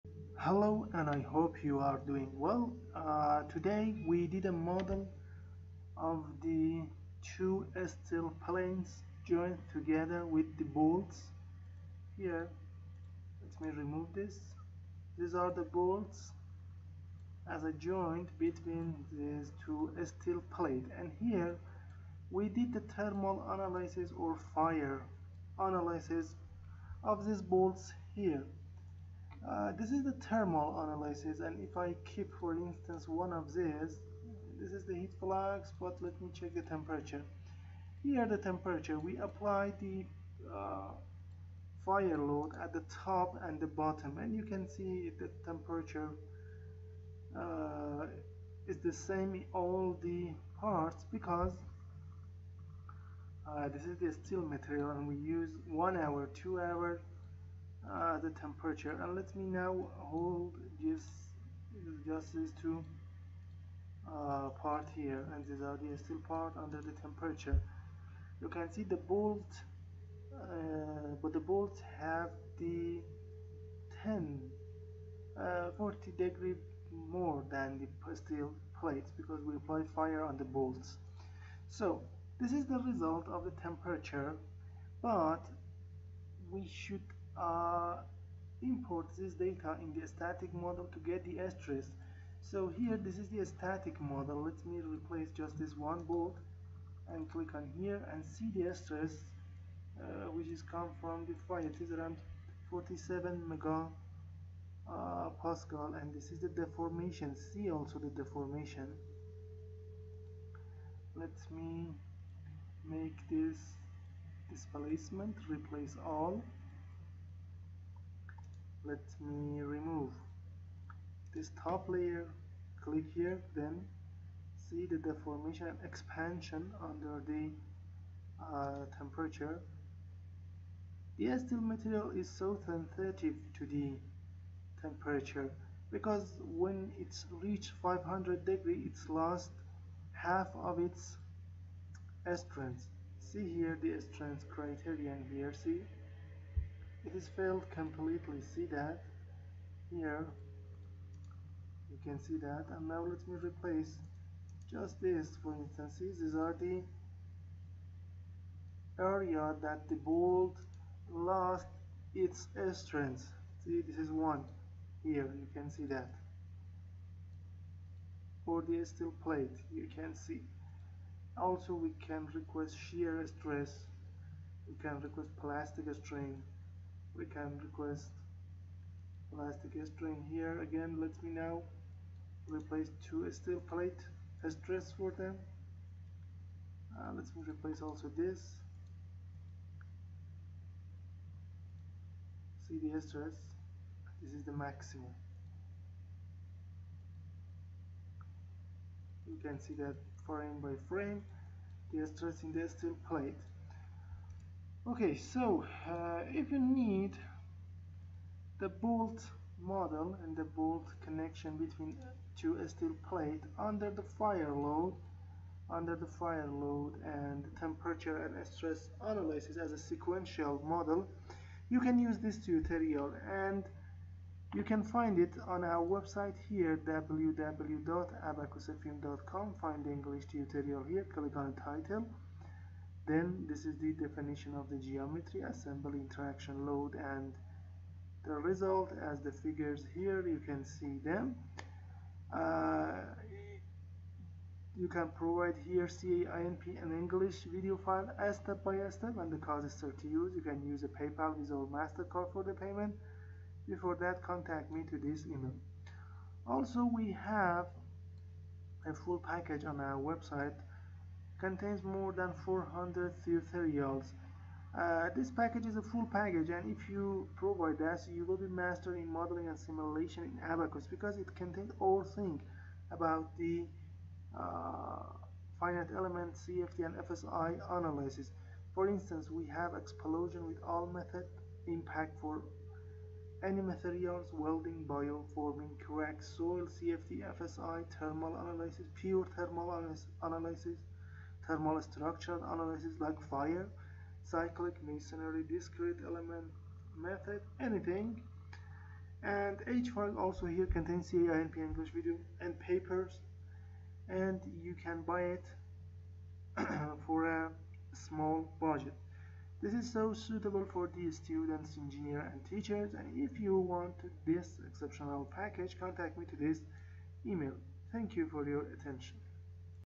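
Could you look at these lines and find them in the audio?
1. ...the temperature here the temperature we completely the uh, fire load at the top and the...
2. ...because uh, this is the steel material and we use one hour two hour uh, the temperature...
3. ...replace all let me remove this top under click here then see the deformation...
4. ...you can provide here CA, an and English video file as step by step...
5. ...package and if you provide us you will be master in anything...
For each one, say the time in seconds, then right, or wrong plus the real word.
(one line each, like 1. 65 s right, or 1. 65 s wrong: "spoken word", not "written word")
1. 36 s wrong: "apply", not "completely"
2. 51 s right
3. 115 s wrong: "layer", not "under"
4. 244 s right
5. 266 s wrong: "modeling", not "anything".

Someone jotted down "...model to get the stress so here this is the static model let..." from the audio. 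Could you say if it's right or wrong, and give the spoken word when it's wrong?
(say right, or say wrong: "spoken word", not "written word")
right.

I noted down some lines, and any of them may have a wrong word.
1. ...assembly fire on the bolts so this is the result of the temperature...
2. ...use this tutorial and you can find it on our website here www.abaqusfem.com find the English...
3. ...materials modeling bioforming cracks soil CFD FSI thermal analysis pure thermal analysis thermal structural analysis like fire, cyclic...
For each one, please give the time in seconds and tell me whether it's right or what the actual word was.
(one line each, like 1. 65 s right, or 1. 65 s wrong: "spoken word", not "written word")
1. 79 s wrong: "apply", not "assembly"
2. 221 s right
3. 283 s wrong: "welding", not "modeling".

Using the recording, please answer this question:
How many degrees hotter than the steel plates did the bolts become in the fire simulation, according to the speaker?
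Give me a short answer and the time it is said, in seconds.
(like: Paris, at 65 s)
40, at 75 s.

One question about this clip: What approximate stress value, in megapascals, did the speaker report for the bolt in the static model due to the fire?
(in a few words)
47.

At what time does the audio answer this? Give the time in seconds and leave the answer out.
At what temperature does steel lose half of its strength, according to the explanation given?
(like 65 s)
137 s.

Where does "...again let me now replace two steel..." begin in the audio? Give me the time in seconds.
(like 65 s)
180 s.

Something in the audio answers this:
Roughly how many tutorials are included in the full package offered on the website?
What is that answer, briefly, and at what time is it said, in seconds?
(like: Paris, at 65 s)
more than 400, at 261 s.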